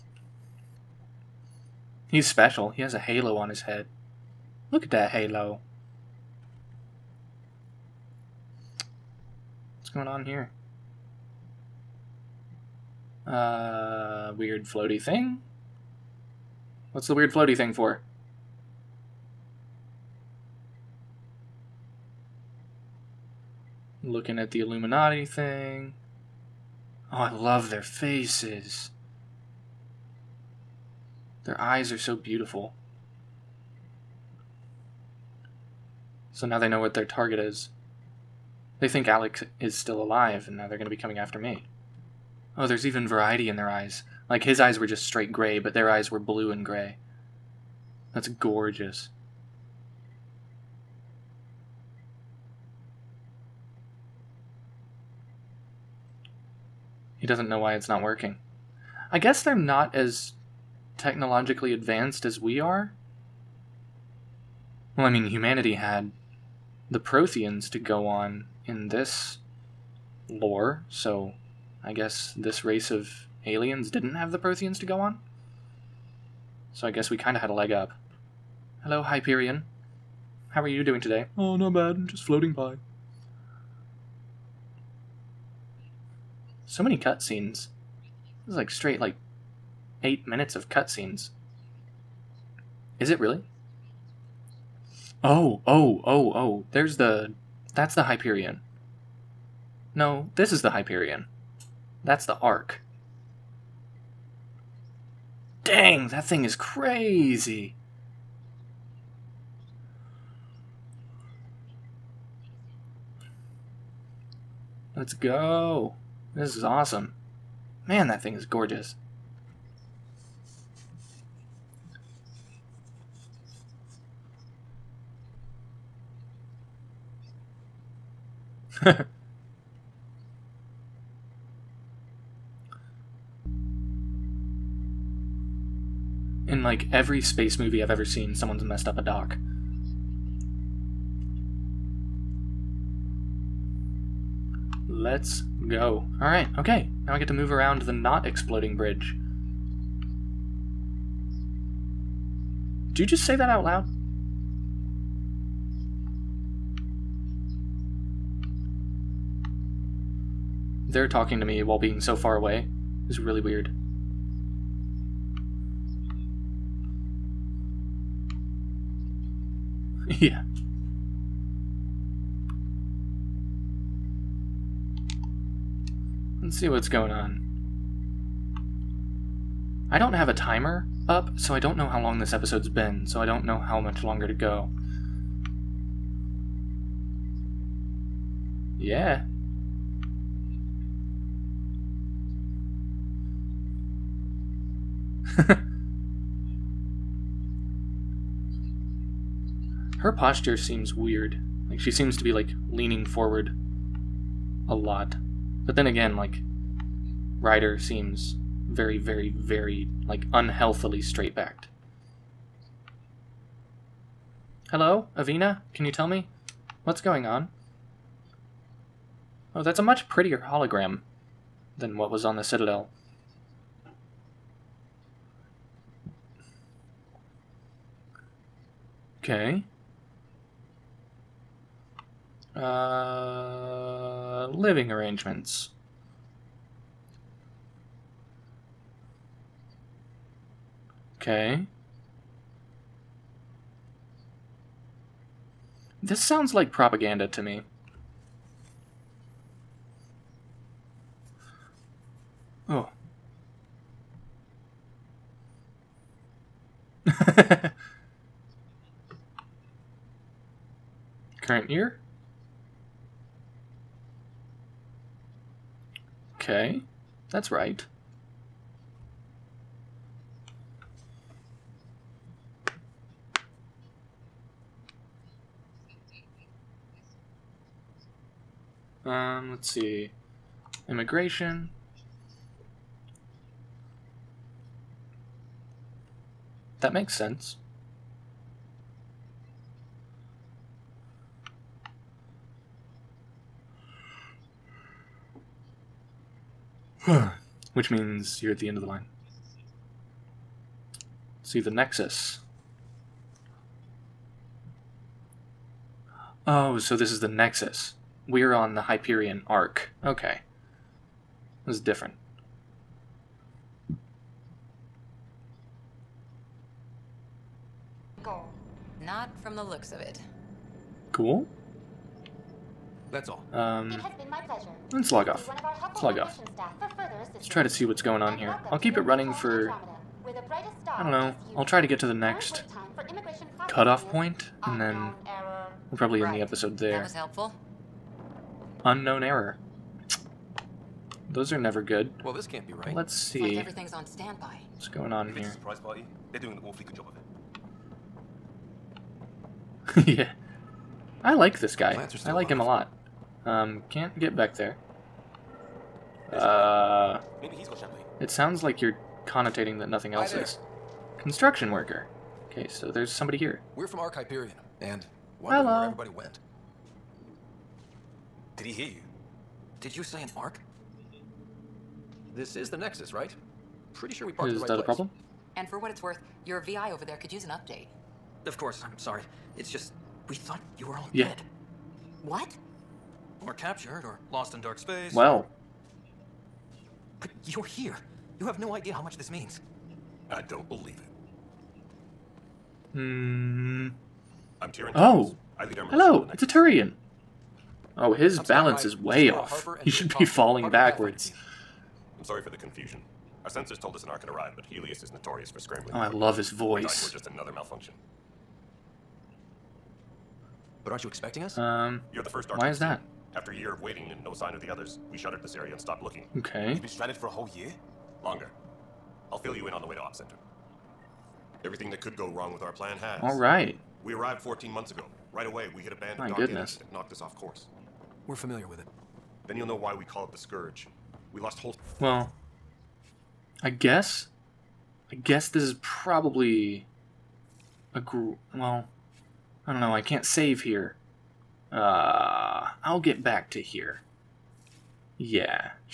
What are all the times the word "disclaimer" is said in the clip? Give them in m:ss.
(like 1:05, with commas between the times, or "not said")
not said.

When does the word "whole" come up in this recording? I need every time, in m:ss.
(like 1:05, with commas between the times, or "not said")
6:57, 7:11.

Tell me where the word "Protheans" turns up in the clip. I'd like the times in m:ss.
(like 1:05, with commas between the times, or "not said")
1:06, 1:14.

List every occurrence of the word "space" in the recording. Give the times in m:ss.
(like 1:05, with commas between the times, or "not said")
2:17, 6:24.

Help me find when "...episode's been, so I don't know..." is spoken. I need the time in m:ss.
3:02.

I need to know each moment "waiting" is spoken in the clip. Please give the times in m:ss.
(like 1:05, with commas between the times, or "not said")
6:53.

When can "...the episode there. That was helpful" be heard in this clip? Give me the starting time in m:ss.
5:36.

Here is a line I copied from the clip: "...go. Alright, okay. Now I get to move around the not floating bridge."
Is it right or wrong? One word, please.
wrong.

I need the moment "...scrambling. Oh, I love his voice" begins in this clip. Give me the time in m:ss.
6:45.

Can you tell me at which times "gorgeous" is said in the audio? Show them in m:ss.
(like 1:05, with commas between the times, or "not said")
0:48, 1:58.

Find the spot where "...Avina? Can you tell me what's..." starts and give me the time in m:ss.
3:35.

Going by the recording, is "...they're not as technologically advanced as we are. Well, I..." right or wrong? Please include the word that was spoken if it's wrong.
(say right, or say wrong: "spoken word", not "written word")
right.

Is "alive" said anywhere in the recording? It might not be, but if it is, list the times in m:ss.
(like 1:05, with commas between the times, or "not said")
0:39, 5:52.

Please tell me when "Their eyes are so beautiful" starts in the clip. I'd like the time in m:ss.
0:31.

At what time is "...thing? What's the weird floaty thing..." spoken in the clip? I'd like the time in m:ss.
0:14.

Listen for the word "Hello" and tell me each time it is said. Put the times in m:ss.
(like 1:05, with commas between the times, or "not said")
1:18, 3:34, 6:05, 6:35.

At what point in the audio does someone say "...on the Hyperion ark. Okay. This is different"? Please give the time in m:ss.
5:08.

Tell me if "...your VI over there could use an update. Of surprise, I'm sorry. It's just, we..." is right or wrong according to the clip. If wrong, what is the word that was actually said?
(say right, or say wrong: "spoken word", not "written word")
wrong: "course", not "surprise".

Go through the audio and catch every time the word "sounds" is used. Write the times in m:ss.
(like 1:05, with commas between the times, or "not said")
4:06, 5:58.